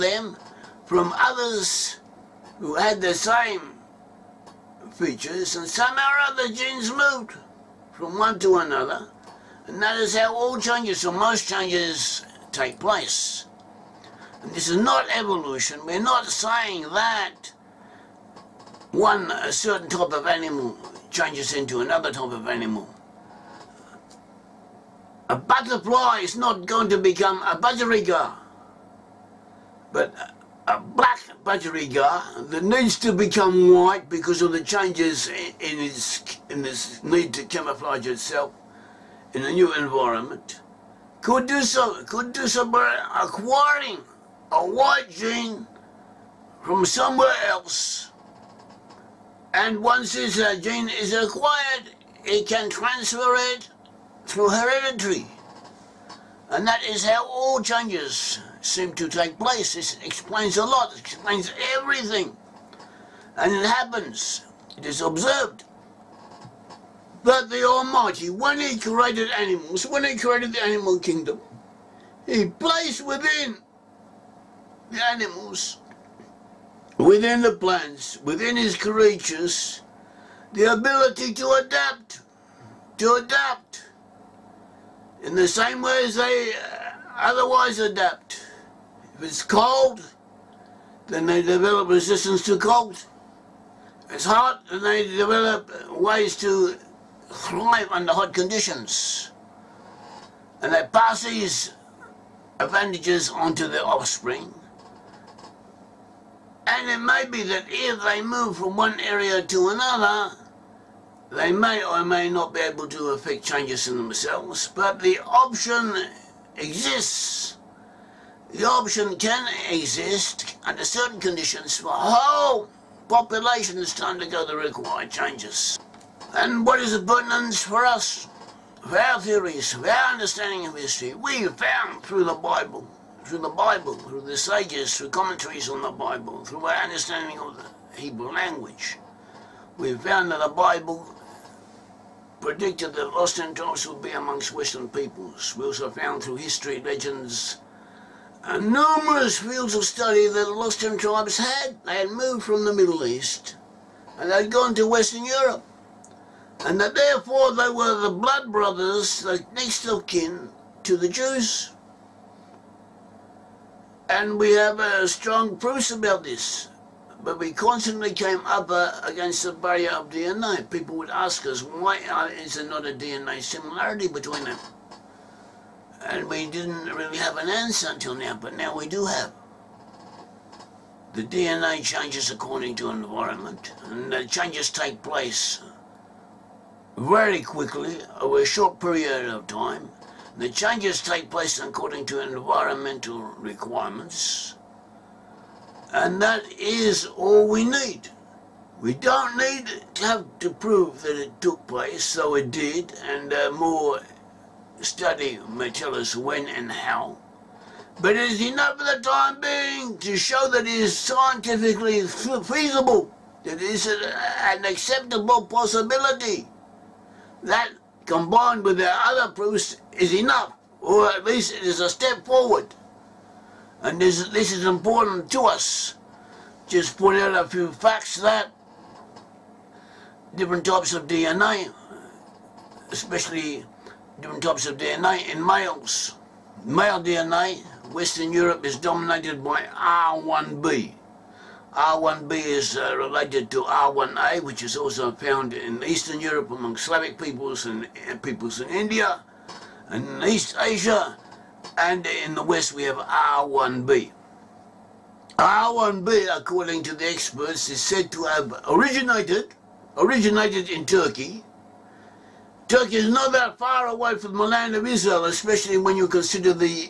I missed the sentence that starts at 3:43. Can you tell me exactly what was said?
And this, this is important to us.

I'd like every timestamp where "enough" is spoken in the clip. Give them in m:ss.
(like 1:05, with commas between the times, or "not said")
3:28, 3:40.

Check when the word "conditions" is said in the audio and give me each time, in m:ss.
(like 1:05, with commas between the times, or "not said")
1:38, 2:01.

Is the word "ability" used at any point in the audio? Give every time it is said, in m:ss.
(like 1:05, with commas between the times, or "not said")
1:20.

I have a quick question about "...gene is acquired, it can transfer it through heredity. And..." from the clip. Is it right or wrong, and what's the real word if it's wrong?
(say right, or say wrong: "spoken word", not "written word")
right.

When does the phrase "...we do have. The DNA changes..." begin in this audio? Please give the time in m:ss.
2:58.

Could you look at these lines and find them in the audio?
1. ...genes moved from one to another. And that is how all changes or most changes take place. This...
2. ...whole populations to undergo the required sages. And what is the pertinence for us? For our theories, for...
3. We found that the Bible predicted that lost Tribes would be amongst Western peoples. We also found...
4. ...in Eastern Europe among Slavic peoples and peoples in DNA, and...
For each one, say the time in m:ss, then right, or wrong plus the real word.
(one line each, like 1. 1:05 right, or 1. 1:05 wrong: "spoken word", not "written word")
1. 0:06 right
2. 2:01 wrong: "changes", not "sages"
3. 2:19 right
4. 4:05 wrong: "India", not "DNA".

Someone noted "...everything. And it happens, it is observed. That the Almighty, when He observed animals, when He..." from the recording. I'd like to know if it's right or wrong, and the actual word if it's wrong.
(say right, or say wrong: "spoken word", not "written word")
wrong: "created", not "observed".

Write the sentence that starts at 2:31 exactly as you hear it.
They had moved from the Middle East and they'd gone to Western Europe.